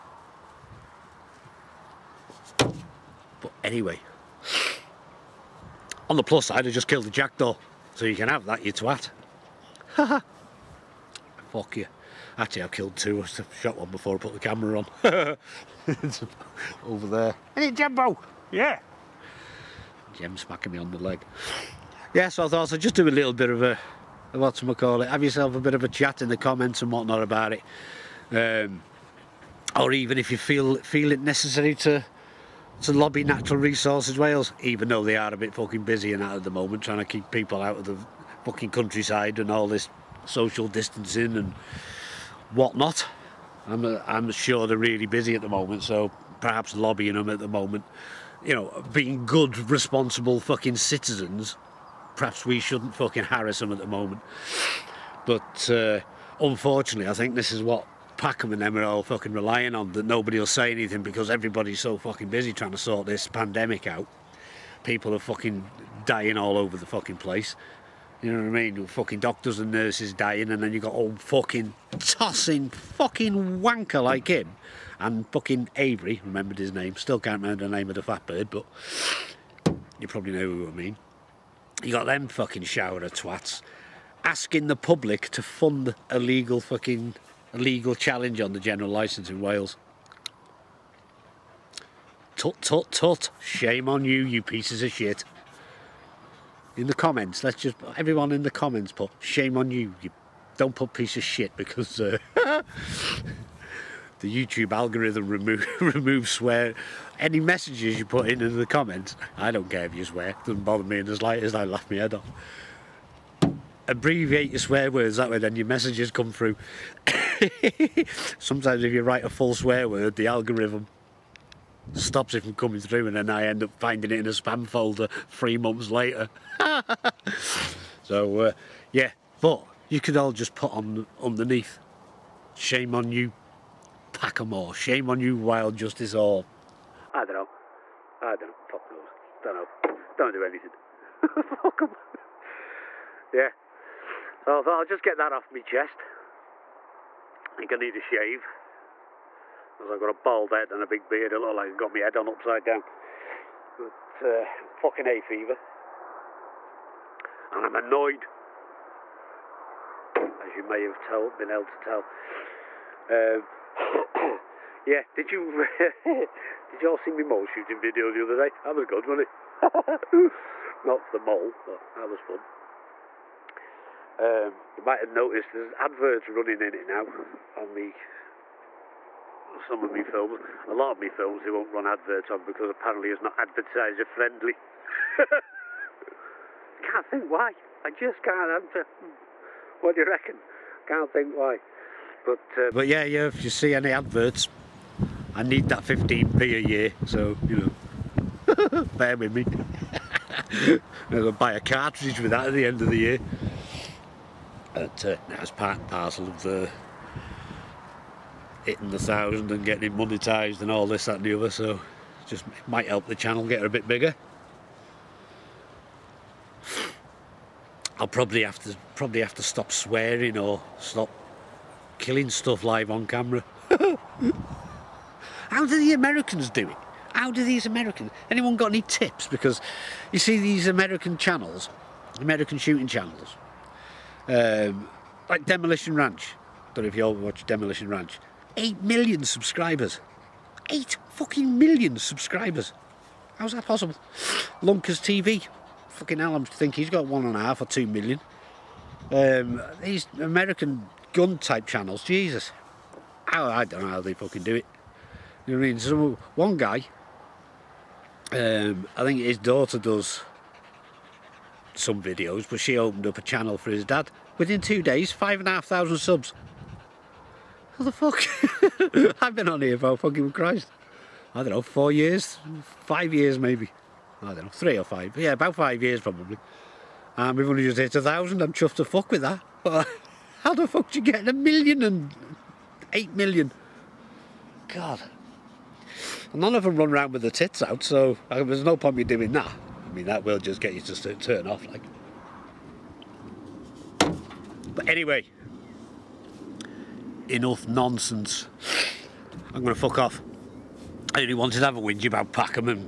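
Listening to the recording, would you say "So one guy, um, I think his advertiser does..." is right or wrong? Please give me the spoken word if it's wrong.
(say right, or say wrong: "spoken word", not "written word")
wrong: "daughter", not "advertiser".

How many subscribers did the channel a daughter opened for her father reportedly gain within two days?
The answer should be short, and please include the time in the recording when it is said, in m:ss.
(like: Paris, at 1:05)
5,500, at 4:25.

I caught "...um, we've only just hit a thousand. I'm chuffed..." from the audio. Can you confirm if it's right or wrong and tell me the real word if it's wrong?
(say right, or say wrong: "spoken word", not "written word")
right.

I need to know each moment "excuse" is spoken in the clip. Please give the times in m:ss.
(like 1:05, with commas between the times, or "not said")
not said.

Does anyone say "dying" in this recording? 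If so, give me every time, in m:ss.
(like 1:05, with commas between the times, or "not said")
1:06, 1:10.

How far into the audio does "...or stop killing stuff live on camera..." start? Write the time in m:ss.
3:40.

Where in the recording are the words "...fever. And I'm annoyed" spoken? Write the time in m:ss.
2:35.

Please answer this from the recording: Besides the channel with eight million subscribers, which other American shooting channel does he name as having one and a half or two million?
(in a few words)
Lunkers TV.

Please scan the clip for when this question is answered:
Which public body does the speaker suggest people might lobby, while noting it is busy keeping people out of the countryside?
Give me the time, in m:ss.
0:33.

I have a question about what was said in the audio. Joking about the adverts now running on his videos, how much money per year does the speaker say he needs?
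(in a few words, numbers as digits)
15p.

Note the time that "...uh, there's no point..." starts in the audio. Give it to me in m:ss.
4:48.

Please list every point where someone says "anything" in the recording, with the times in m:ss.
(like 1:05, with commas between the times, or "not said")
1:00, 2:20.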